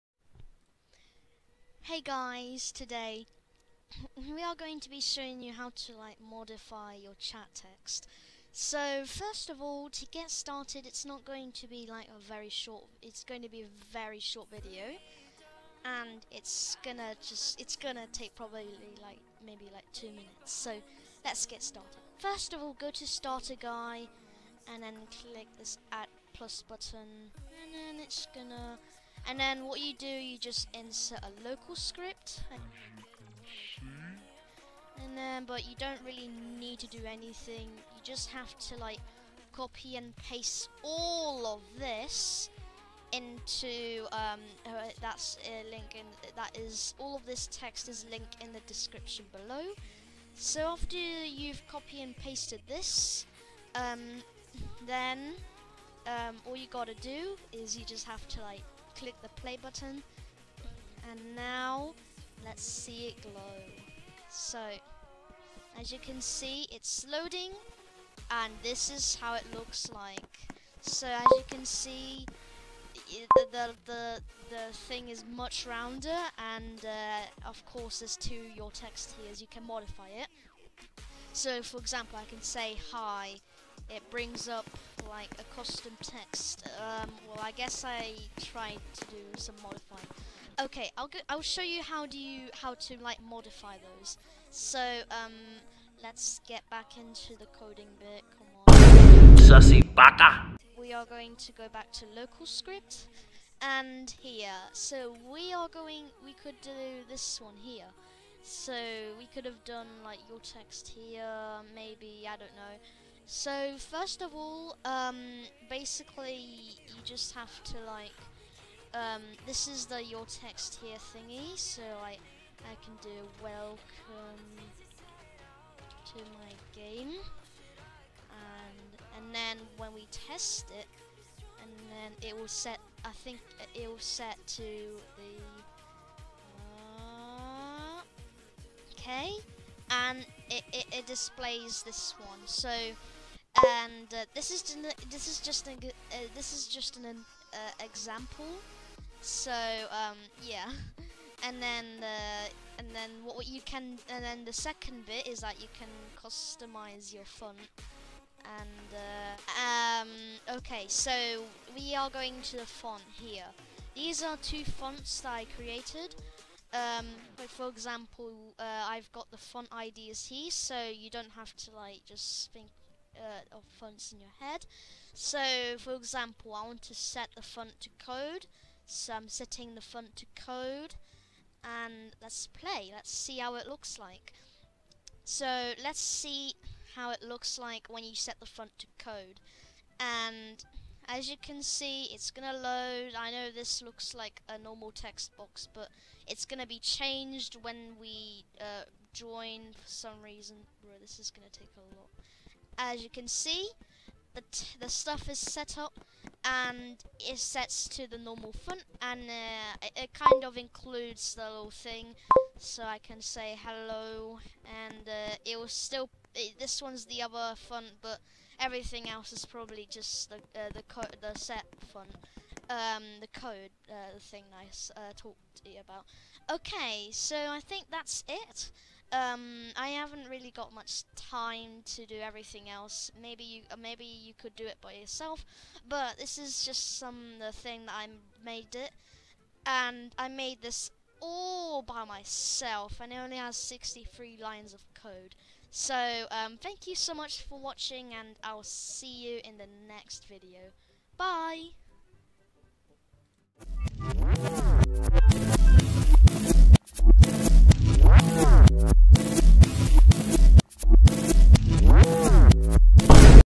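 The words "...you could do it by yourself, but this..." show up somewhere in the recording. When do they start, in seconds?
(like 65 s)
234 s.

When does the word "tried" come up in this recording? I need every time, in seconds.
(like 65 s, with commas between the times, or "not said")
88 s.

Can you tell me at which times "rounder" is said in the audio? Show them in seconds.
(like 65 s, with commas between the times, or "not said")
75 s.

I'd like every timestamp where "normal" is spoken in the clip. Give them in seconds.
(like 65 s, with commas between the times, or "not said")
194 s, 208 s.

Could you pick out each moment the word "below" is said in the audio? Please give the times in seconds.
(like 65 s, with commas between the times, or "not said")
49 s.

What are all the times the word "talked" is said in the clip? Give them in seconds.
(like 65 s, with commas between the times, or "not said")
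225 s.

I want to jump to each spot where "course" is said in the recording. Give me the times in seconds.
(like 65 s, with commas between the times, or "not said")
77 s.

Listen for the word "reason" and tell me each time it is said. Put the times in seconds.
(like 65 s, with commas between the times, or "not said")
200 s.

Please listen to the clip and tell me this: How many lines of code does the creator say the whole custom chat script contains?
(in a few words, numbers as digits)
63.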